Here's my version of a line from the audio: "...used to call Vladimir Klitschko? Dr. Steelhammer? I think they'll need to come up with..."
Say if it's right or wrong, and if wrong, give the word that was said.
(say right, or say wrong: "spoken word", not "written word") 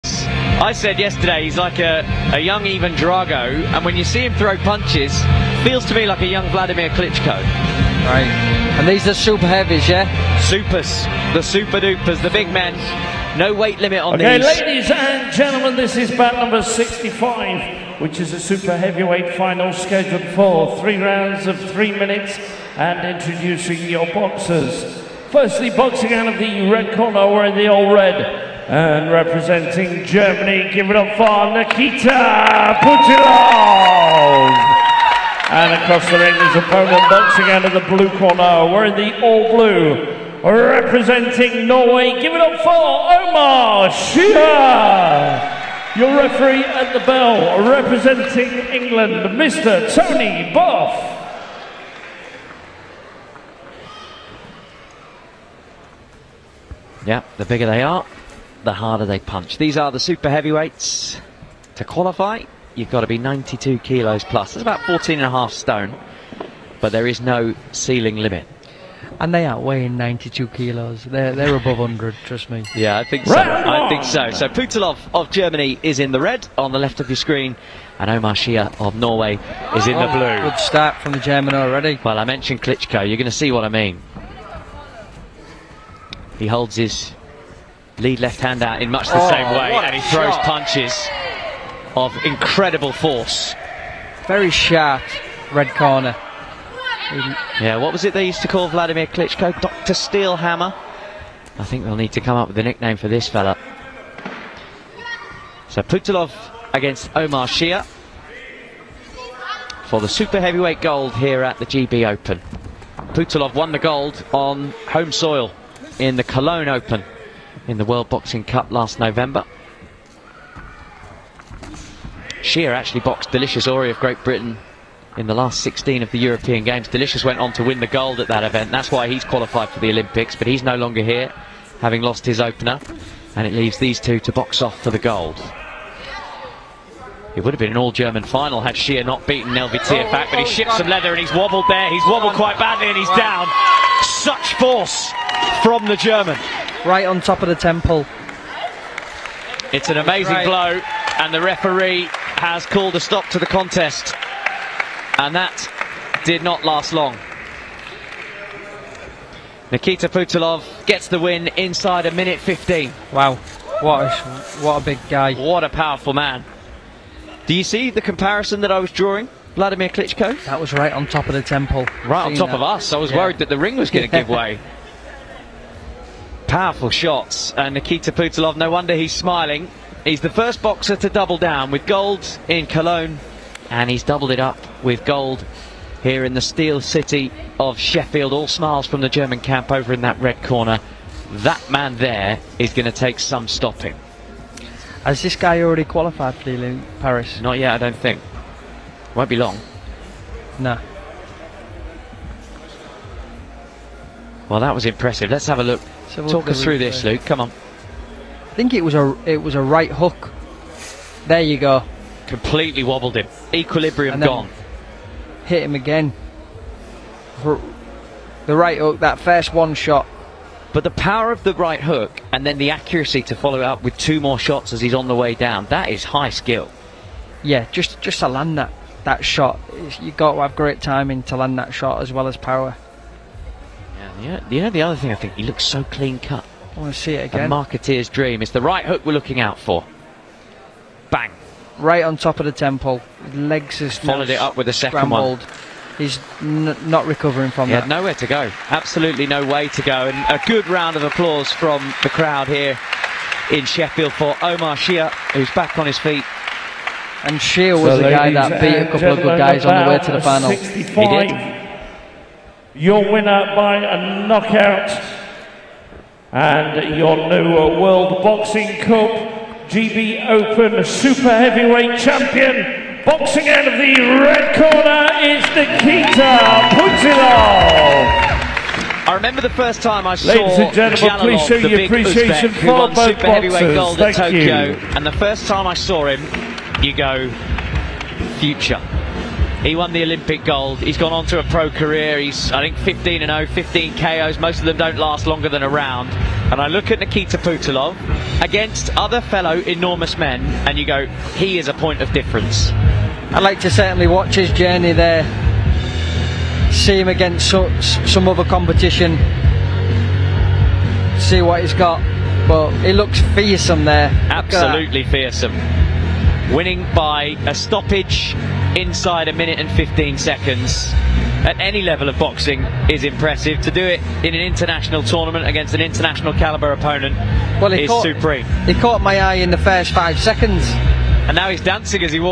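right.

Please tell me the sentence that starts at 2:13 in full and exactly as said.
And it leaves these two to box off for the gold.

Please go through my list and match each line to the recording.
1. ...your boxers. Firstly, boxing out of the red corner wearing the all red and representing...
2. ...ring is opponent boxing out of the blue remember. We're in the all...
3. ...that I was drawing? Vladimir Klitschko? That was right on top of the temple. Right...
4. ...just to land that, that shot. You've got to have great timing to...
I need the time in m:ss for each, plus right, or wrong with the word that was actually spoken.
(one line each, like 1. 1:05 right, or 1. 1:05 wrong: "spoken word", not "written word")
1. 0:23 right
2. 0:36 wrong: "corner", not "remember"
3. 2:48 right
4. 3:48 right.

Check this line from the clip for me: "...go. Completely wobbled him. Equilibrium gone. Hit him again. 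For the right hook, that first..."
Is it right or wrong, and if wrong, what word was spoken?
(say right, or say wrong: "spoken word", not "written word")
right.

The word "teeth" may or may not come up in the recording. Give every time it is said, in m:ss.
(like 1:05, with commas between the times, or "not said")
not said.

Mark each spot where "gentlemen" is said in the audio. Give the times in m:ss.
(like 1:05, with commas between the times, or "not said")
0:15, 4:40.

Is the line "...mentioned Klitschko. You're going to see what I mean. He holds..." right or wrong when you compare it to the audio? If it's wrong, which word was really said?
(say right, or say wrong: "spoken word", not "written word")
right.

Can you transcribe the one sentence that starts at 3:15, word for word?
Has this guy already qualified for the Paris?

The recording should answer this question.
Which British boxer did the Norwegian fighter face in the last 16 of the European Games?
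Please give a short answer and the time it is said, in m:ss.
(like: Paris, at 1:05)
Delicious Orie, at 2:03.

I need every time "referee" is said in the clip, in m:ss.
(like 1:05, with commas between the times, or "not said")
0:46, 2:31.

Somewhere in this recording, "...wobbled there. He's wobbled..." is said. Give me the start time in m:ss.
2:21.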